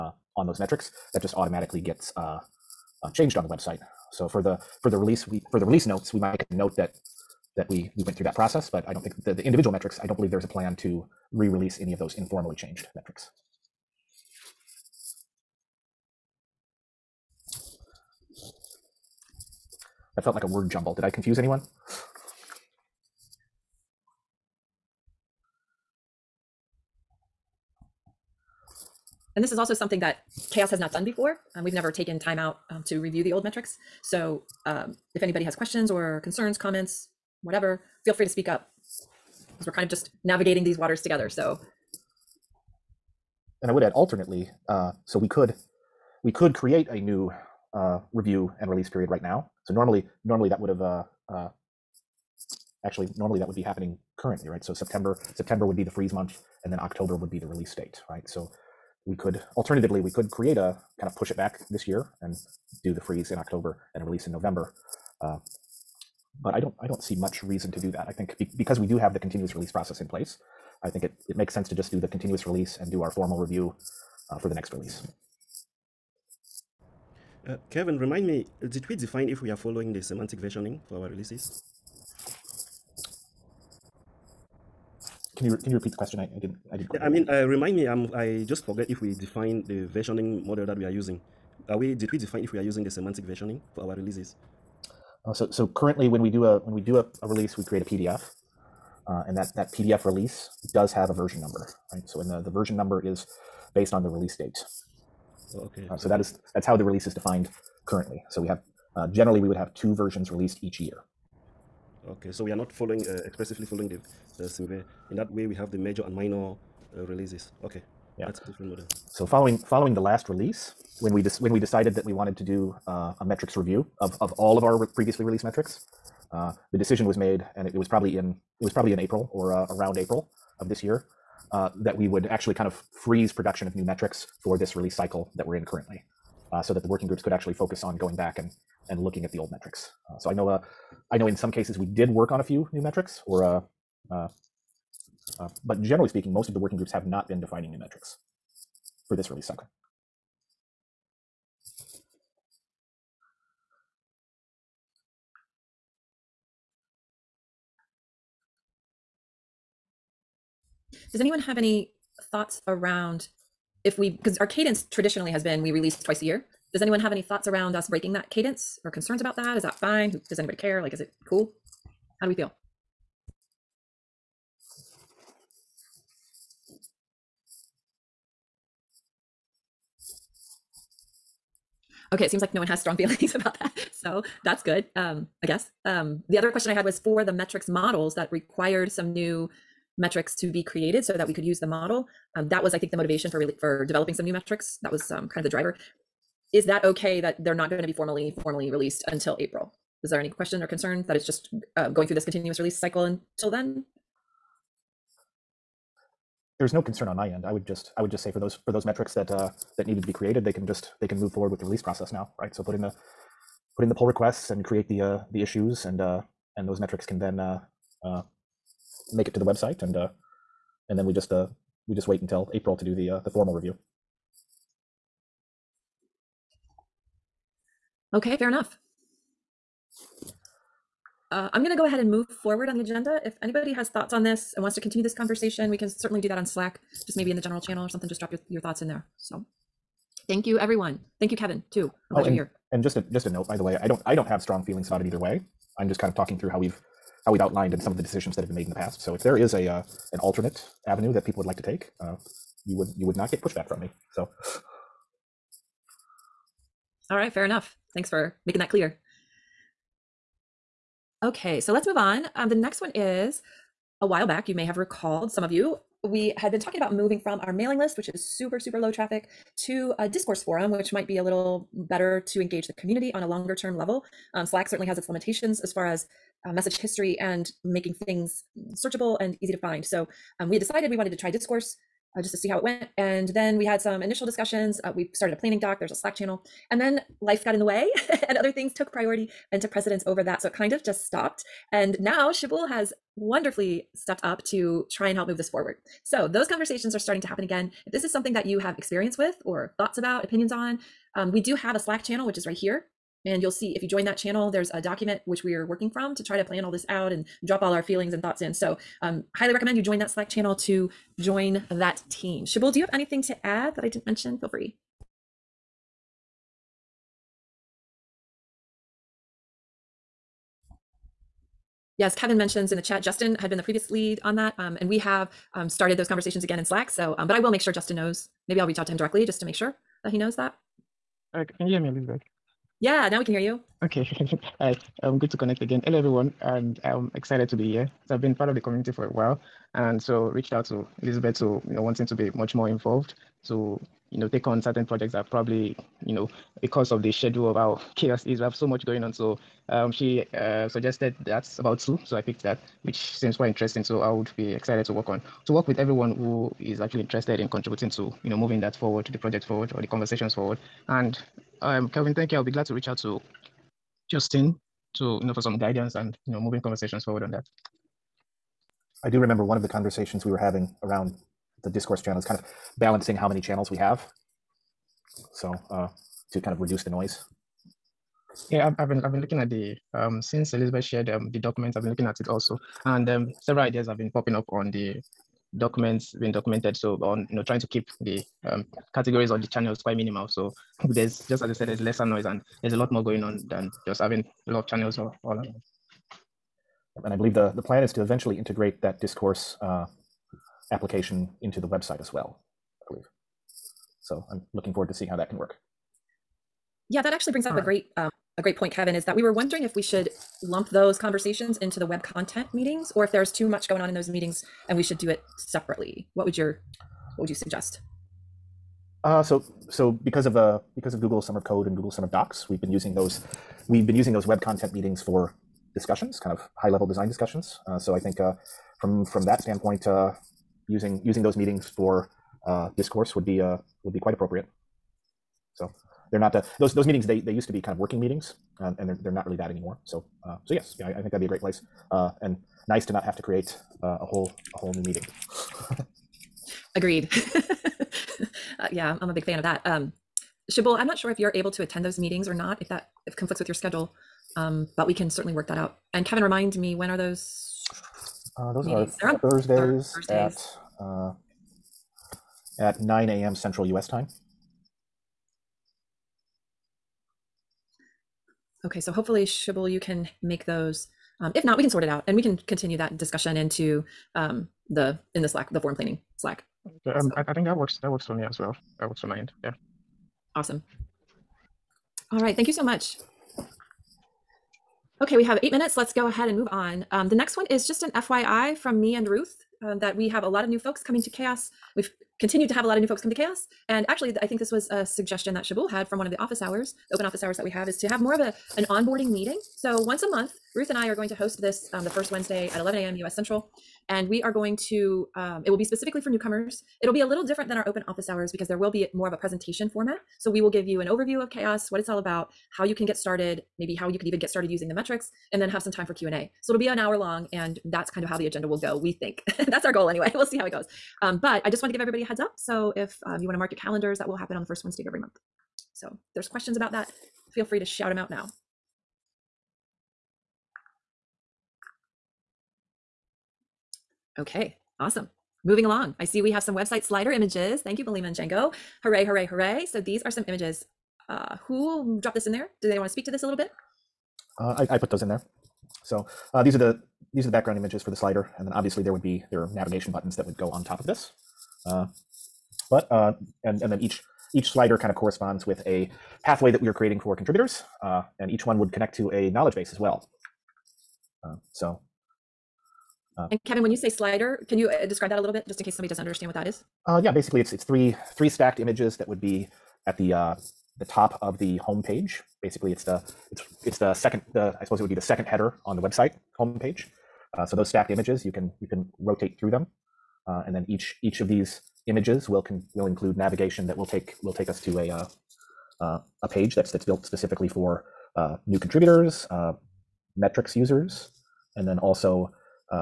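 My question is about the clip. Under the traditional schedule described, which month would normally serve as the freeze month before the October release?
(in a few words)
September.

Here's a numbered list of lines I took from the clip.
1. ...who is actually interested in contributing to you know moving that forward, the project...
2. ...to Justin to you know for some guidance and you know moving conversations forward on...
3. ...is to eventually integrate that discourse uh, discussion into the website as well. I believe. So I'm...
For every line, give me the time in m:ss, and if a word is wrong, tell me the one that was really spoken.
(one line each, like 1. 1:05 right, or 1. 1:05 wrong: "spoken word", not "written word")
1. 5:56 right
2. 6:03 right
3. 6:37 wrong: "application", not "discussion".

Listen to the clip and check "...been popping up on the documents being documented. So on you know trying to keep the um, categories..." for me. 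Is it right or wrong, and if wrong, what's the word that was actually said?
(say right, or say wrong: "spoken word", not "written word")
right.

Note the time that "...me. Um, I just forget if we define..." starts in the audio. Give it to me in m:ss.
1:27.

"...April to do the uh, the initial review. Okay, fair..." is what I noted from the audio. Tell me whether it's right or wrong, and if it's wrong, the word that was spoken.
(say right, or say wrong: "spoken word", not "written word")
wrong: "formal", not "initial".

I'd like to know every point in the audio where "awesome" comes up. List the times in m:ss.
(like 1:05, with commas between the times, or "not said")
8:00, 8:54.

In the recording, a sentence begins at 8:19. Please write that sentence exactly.
So once a month, Ruth and I are going to host this um, the first Wednesday at 11 a.m.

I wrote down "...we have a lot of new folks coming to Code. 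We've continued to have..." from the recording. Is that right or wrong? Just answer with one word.
wrong.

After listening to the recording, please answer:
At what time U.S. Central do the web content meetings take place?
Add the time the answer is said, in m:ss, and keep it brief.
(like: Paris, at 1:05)
9 a.m., at 7:42.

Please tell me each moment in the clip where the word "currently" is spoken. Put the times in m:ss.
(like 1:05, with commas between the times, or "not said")
0:54, 1:35, 1:47, 2:15.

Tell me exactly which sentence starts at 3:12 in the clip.
Um, that was, I think, the motivation for really for developing some new metrics.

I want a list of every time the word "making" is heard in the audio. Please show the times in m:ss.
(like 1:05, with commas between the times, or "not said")
4:18, 4:37.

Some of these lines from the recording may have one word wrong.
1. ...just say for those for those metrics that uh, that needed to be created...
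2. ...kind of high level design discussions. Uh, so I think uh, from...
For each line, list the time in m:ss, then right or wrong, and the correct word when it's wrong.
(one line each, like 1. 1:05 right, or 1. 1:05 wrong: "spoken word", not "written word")
1. 3:28 right
2. 7:06 right.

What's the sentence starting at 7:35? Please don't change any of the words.
And Kevin, remind me, when are those?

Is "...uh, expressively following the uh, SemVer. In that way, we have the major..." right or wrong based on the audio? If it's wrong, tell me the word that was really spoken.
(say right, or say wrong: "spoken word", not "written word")
right.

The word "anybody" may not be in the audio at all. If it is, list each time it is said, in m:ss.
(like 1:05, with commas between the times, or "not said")
0:35, 2:50, 3:53.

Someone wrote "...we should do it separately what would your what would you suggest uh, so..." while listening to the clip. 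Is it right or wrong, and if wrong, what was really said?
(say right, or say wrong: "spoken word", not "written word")
right.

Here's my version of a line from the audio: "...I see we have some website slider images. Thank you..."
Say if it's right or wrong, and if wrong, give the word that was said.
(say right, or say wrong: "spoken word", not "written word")
right.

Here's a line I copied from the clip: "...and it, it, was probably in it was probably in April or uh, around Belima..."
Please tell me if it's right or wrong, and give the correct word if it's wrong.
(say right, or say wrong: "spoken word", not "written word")
wrong: "April", not "Belima".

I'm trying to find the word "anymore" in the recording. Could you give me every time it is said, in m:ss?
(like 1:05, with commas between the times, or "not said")
7:19.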